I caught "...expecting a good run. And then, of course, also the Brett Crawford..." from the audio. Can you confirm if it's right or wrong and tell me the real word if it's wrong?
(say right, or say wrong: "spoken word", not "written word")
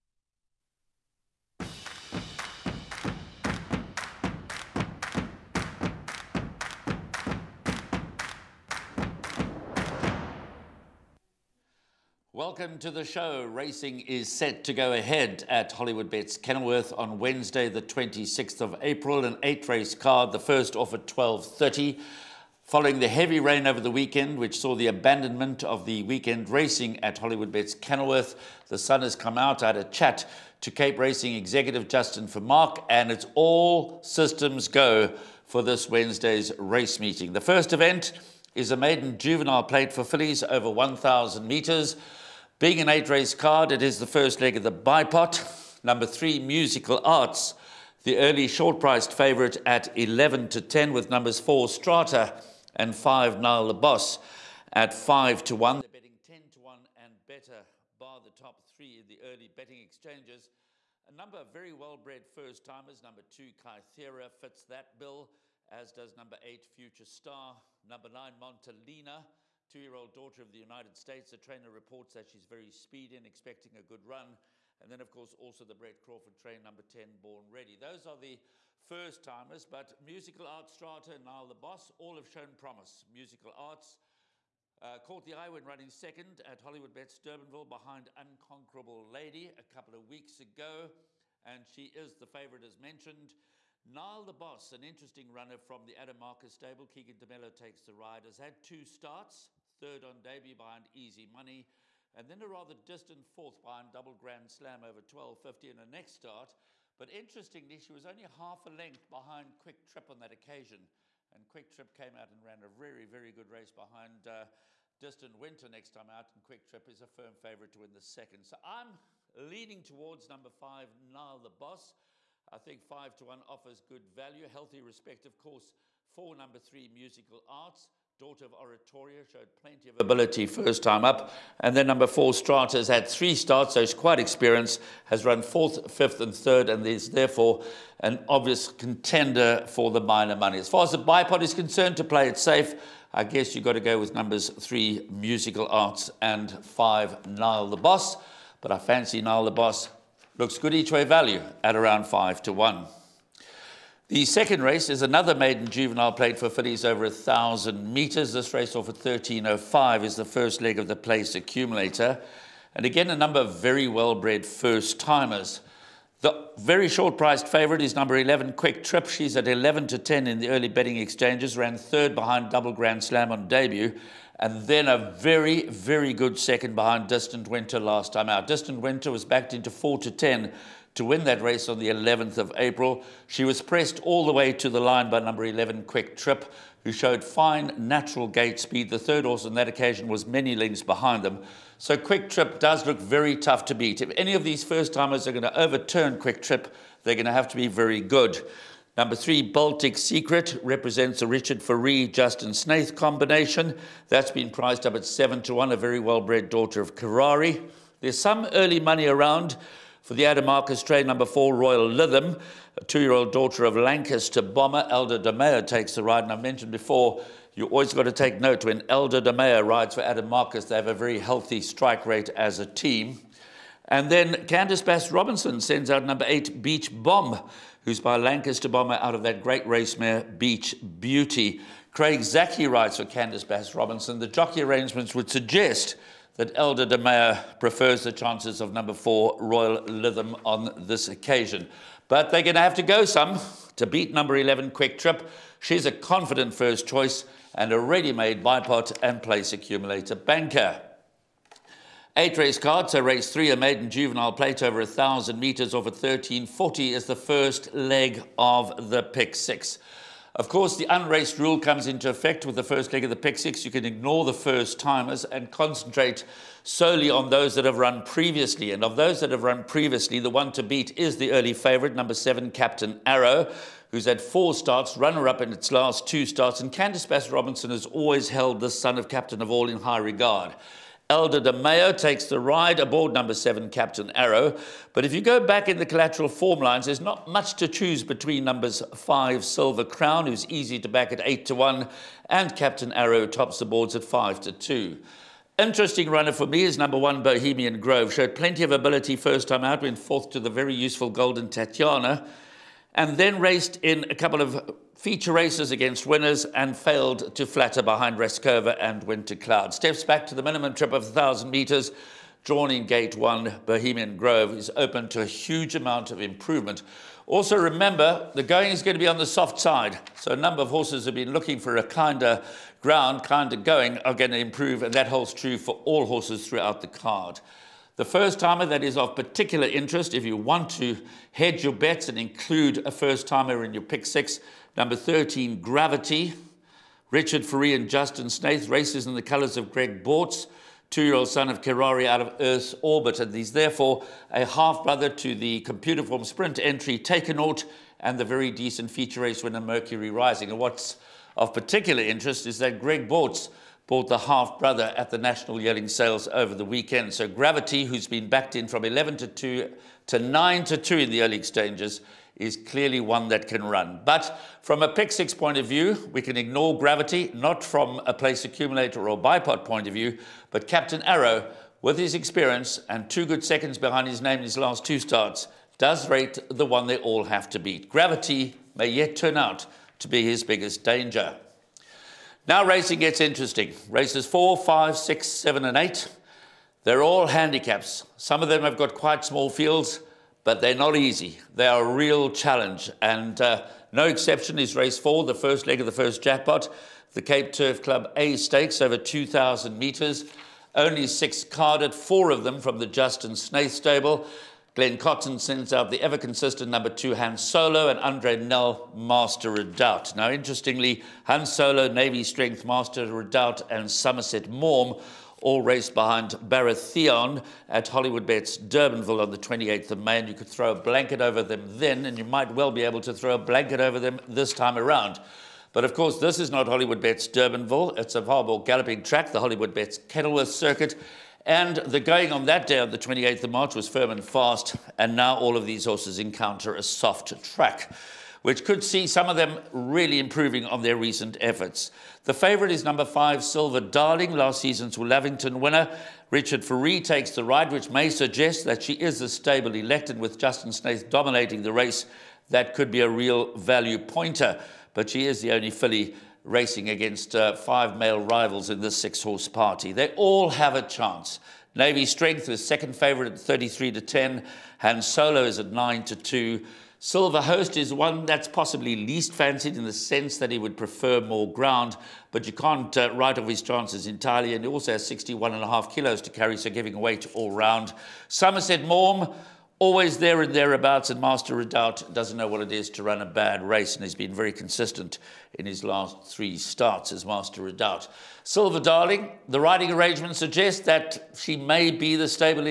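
right.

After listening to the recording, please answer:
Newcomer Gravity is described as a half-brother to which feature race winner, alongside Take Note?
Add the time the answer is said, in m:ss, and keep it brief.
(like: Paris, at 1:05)
Mercury Rising, at 5:49.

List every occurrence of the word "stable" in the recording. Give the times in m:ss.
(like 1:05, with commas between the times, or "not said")
1:36, 6:43, 7:29.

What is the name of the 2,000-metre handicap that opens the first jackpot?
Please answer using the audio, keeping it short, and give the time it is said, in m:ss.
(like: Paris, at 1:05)
Cape Turf Club A Stakes, at 6:37.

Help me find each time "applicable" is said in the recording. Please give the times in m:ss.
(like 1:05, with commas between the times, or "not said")
not said.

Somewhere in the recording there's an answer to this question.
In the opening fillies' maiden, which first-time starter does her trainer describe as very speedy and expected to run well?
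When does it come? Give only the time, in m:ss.
1:08.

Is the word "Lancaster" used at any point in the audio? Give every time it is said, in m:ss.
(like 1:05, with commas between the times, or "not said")
3:33, 3:48.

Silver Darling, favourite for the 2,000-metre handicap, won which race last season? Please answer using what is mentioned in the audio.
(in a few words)
Lavington.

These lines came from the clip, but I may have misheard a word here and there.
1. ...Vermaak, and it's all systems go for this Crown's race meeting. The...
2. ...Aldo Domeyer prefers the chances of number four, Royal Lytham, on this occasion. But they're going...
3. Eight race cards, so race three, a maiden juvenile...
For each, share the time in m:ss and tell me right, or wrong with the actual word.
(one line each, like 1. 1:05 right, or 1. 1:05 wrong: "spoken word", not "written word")
1. 0:32 wrong: "Wednesday", not "Crown"
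2. 3:56 right
3. 4:12 right.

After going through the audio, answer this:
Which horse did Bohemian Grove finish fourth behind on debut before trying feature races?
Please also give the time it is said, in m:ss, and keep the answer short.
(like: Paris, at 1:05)
Golden Tatiana, at 5:01.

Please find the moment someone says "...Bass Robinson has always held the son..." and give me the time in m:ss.
4:37.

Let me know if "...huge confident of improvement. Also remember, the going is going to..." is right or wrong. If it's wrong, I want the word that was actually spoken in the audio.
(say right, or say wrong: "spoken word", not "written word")
wrong: "amount", not "confident".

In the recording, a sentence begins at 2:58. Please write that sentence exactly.
Distant Winter was backed into 4 to 10 to win that race on the 11th of April.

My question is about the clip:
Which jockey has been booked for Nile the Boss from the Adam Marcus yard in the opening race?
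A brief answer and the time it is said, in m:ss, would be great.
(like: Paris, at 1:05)
Keagan de Melo, at 1:36.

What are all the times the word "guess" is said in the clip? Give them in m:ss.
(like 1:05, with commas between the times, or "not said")
2:23.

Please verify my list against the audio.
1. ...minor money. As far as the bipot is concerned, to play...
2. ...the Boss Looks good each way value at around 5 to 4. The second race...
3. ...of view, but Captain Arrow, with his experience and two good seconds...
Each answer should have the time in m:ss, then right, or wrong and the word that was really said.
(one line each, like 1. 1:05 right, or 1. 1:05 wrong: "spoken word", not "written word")
1. 2:20 right
2. 2:29 wrong: "1", not "4"
3. 6:09 right.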